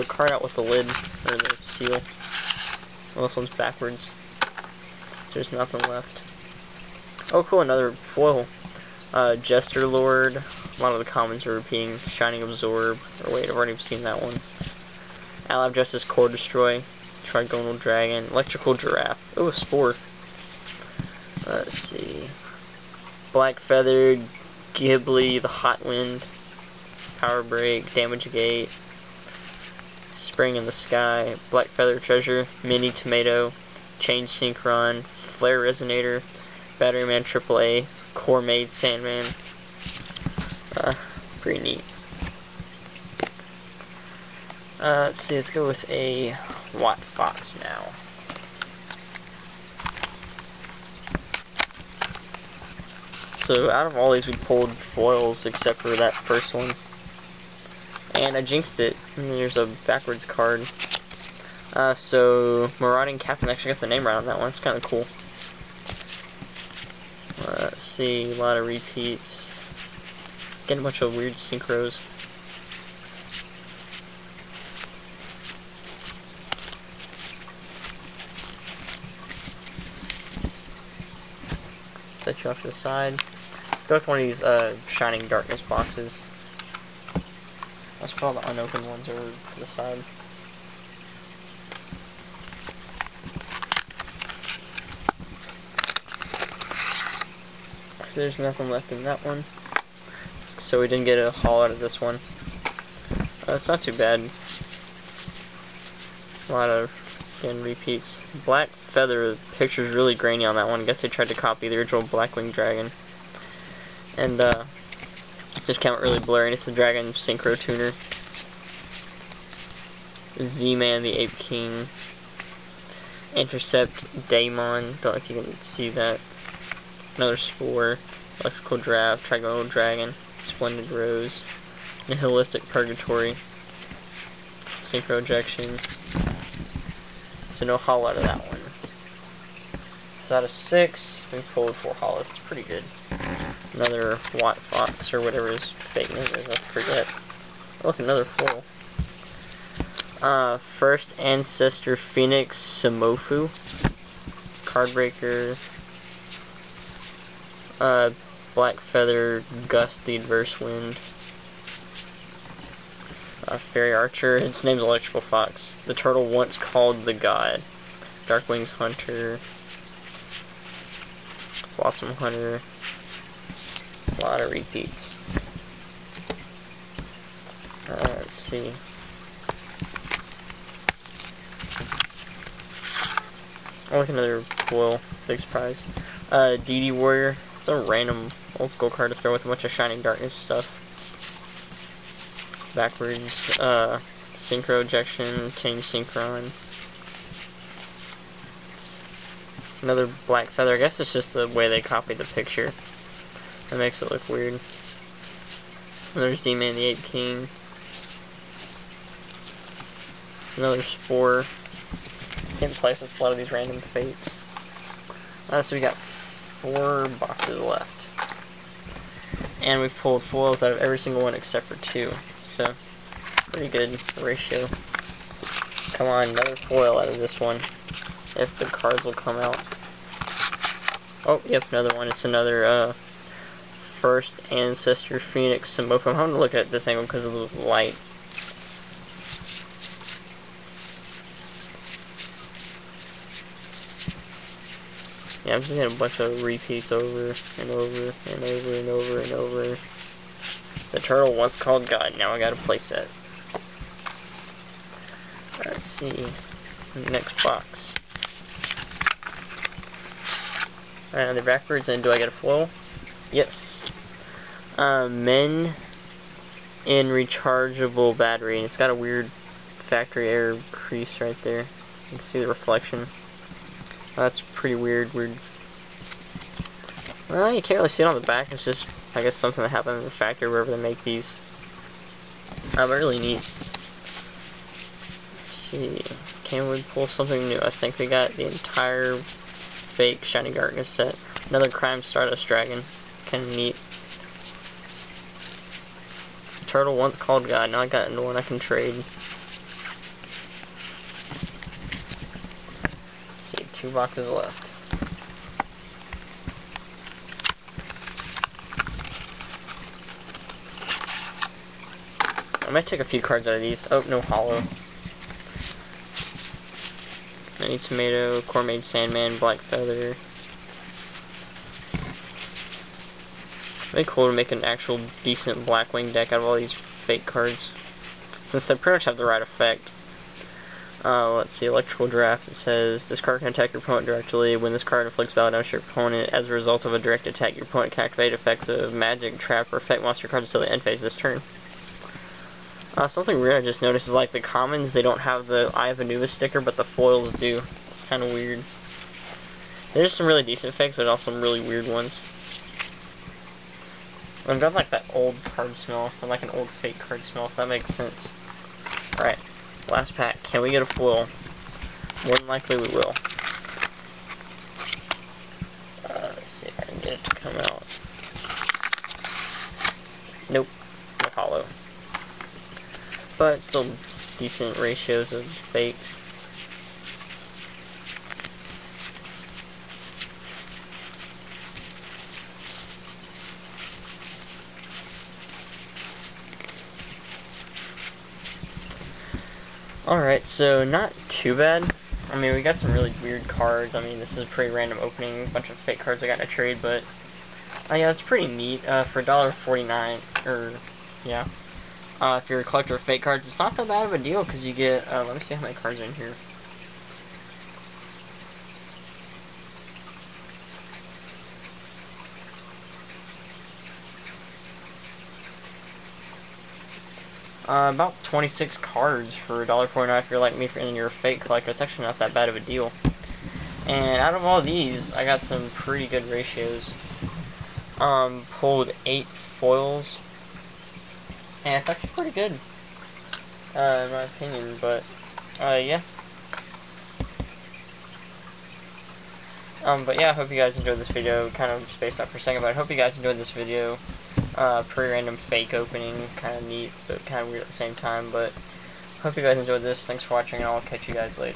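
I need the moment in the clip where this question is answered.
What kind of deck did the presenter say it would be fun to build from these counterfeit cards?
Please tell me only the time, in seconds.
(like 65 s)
325 s.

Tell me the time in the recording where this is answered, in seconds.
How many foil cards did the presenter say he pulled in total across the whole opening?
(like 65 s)
428 s.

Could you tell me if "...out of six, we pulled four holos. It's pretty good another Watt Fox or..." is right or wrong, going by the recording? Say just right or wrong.
right.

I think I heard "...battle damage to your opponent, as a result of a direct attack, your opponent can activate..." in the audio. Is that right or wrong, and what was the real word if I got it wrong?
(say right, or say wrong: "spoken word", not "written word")
right.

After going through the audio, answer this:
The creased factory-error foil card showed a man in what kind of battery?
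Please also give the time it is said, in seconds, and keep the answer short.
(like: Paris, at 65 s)
rechargeable battery, at 267 s.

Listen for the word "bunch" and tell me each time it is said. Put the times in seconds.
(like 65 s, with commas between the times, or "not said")
70 s, 189 s, 245 s, 395 s.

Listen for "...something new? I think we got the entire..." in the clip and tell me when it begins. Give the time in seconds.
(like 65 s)
287 s.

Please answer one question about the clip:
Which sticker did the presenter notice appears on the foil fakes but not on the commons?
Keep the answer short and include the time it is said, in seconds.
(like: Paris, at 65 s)
Eye of Anubis, at 345 s.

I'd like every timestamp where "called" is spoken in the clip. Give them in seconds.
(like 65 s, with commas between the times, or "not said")
166 s, 251 s, 297 s.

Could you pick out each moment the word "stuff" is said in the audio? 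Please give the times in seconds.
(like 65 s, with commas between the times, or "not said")
190 s.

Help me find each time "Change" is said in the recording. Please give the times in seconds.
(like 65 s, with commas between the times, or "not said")
33 s, 195 s.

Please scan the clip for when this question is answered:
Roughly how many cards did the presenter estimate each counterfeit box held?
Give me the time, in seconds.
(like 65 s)
417 s.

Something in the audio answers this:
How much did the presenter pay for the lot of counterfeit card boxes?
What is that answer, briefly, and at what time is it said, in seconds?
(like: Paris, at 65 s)
$1.49, at 399 s.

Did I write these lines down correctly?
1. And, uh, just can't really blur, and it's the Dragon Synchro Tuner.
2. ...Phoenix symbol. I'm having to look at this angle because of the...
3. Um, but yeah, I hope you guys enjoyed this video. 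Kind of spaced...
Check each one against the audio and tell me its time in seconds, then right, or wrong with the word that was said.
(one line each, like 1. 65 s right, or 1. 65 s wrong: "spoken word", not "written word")
1. 114 s right
2. 235 s right
3. 439 s right.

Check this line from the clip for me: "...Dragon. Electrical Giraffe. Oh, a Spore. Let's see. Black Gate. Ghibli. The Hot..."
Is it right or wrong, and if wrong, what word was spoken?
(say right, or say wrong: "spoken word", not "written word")
wrong: "Feathered", not "Gate".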